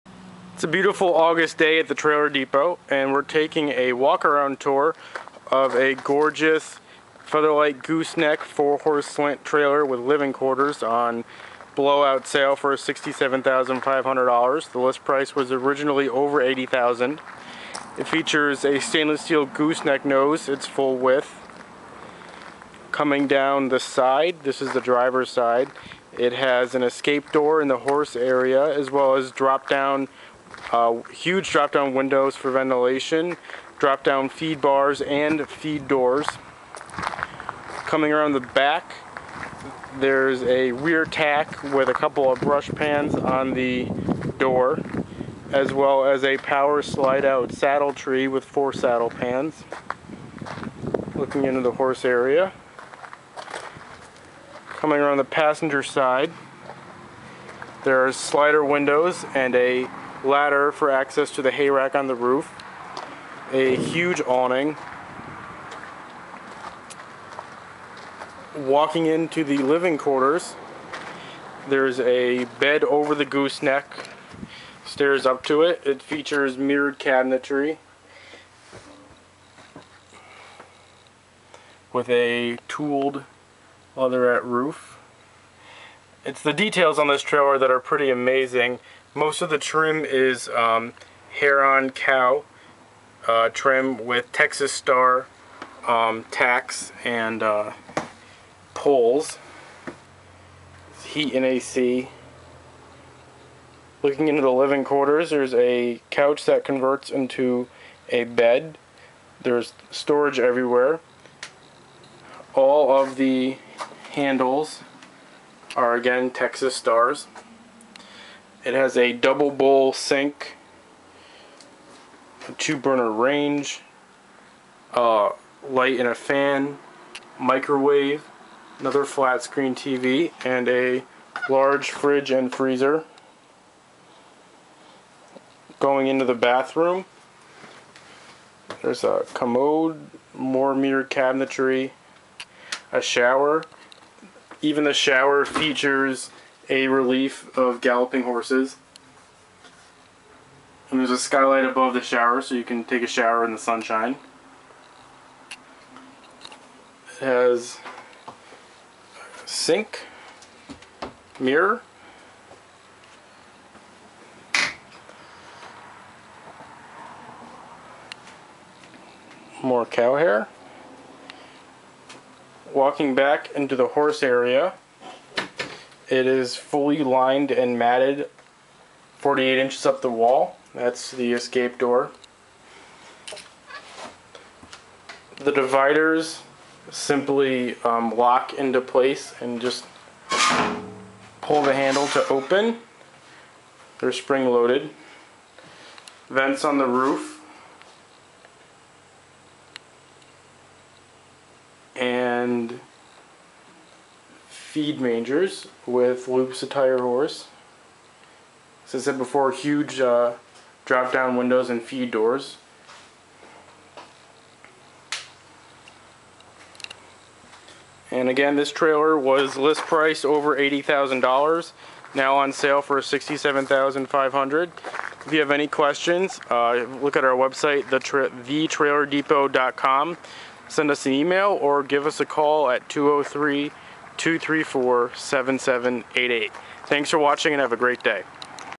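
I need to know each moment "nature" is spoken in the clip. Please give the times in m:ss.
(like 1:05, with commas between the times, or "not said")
not said.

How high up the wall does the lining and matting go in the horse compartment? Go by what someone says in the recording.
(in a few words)
48 inches.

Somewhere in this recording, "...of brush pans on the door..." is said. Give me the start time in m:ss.
0:42.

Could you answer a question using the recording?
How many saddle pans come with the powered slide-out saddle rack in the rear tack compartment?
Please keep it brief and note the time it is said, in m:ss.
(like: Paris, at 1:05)
4, at 0:48.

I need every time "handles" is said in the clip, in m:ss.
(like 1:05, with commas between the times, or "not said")
1:54, 3:11.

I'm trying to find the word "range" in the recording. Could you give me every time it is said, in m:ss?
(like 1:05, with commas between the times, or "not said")
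2:03.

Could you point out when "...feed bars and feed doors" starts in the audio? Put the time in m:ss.
0:34.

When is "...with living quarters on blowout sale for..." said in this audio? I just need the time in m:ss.
0:09.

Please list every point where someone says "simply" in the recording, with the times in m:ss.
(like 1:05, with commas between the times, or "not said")
3:06.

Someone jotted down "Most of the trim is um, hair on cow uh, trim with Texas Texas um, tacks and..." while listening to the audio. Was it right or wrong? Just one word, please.
wrong.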